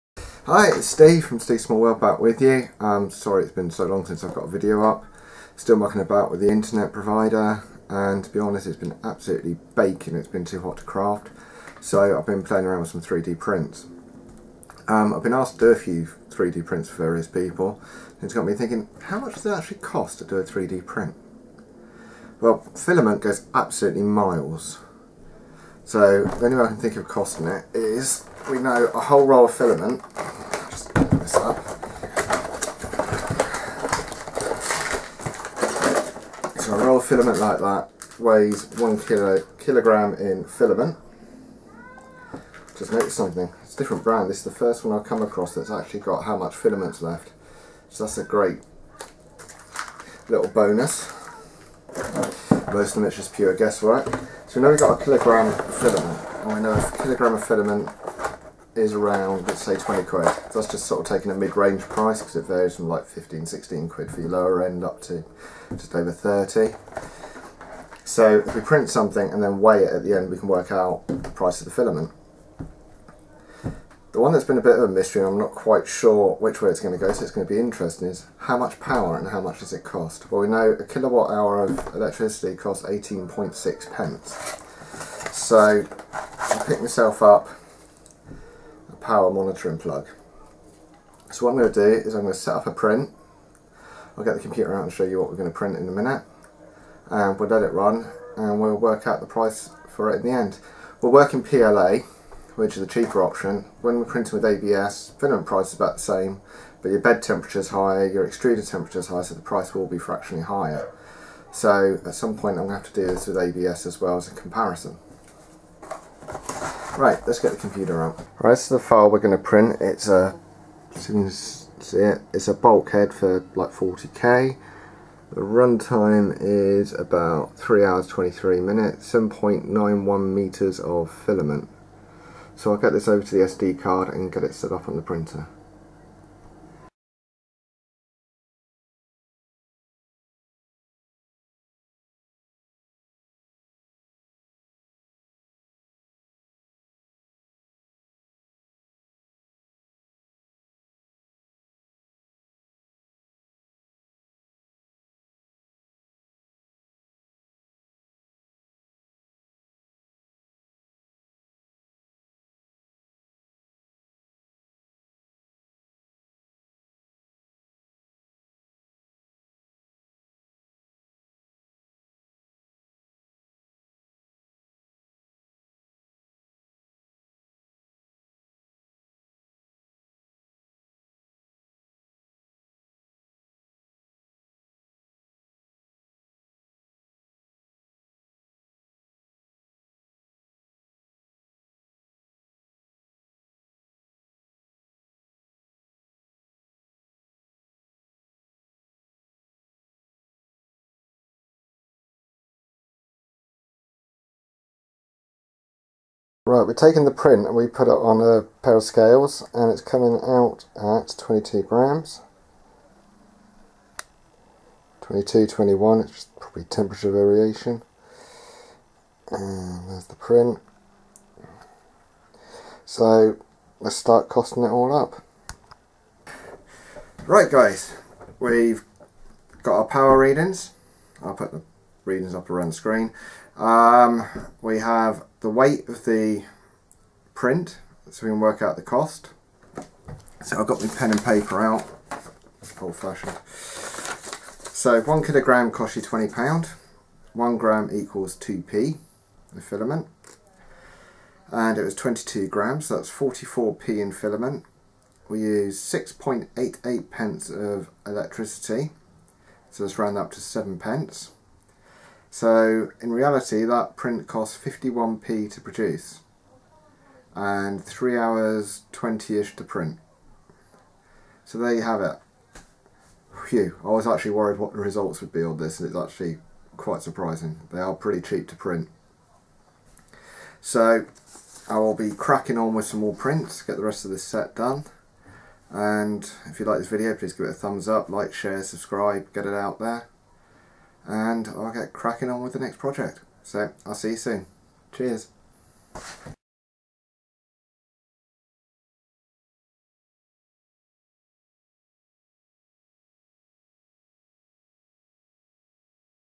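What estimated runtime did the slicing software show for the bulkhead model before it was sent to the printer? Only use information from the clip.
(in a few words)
3 hours 23 minutes.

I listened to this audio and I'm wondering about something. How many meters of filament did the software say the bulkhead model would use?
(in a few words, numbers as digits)
7.91 meters.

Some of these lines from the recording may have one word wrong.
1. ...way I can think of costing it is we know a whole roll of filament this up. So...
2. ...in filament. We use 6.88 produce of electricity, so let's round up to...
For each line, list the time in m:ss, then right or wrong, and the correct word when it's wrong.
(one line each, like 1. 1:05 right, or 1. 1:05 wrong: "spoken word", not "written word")
1. 0:26 right
2. 4:14 wrong: "pence", not "produce".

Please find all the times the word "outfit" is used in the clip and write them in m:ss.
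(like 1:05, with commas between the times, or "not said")
not said.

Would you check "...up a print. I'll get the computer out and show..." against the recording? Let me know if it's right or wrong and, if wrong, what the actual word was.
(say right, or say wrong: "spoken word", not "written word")
right.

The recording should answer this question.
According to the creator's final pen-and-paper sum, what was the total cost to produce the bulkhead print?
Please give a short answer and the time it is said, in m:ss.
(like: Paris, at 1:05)
51p, at 4:24.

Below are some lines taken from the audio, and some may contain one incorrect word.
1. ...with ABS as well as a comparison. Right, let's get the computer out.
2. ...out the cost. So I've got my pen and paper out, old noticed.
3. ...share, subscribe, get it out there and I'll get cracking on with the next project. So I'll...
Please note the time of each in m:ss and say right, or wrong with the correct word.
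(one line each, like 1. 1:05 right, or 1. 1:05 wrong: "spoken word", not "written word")
1. 1:53 right
2. 3:58 wrong: "fashioned", not "noticed"
3. 4:48 right.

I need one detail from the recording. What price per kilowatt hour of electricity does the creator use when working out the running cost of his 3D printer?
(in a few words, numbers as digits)
18.6 pence.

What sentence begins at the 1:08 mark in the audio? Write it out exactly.
So if we print something and then weigh it at the end, we can work out the price of the filament.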